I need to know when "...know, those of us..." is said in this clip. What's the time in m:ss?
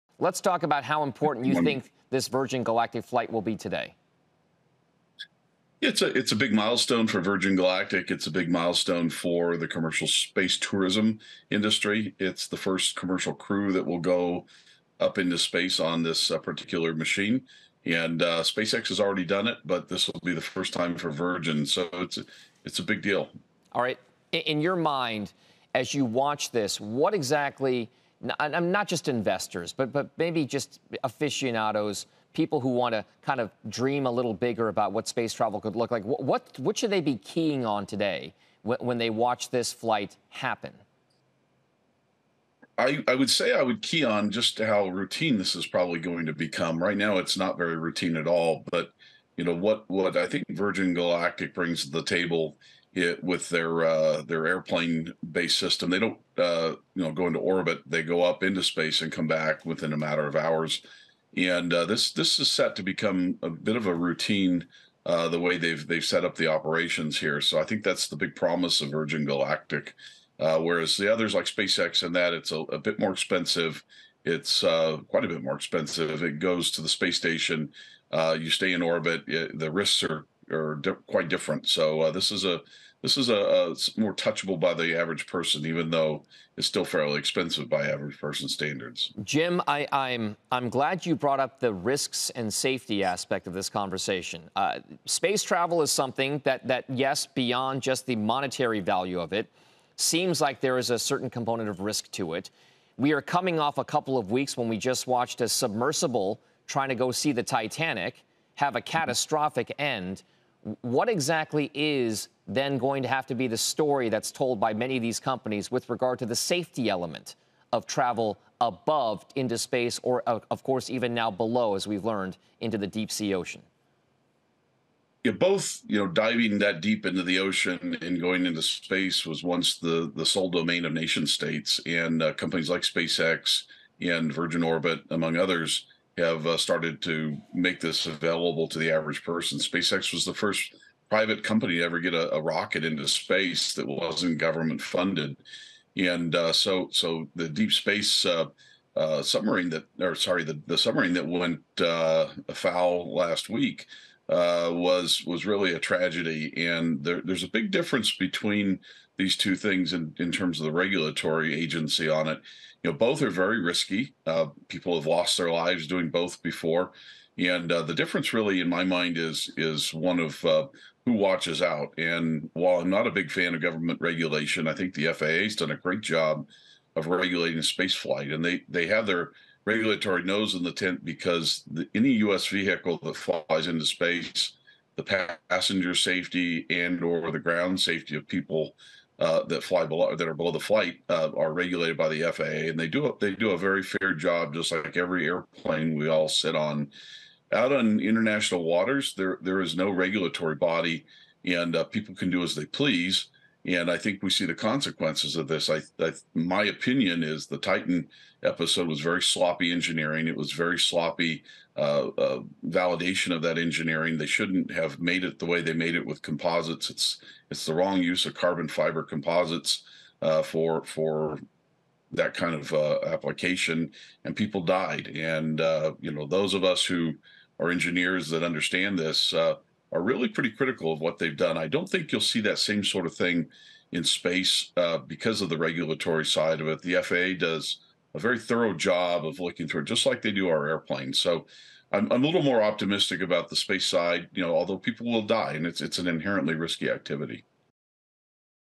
3:46.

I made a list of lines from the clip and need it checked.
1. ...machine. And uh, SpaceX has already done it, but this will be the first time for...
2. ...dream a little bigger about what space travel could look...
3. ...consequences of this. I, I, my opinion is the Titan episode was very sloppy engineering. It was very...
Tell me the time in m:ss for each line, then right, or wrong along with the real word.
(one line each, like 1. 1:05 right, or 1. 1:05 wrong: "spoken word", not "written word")
1. 0:16 right
2. 0:33 right
3. 3:24 right.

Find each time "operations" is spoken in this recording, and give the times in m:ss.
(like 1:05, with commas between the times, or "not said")
1:06.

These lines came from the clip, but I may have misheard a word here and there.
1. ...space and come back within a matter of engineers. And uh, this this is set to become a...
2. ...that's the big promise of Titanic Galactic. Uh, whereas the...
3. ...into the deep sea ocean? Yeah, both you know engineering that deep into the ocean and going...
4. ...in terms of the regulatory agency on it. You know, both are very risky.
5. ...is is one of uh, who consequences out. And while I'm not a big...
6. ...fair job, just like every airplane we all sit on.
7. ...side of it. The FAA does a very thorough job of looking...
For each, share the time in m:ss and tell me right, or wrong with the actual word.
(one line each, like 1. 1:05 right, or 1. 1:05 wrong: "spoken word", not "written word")
1. 0:58 wrong: "hours", not "engineers"
2. 1:07 wrong: "Virgin", not "Titanic"
3. 2:02 wrong: "diving", not "engineering"
4. 2:40 right
5. 2:49 wrong: "watches", not "consequences"
6. 3:13 right
7. 3:56 right.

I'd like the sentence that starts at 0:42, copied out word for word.
I, I, would say I would key on just how routine this is probably going to become.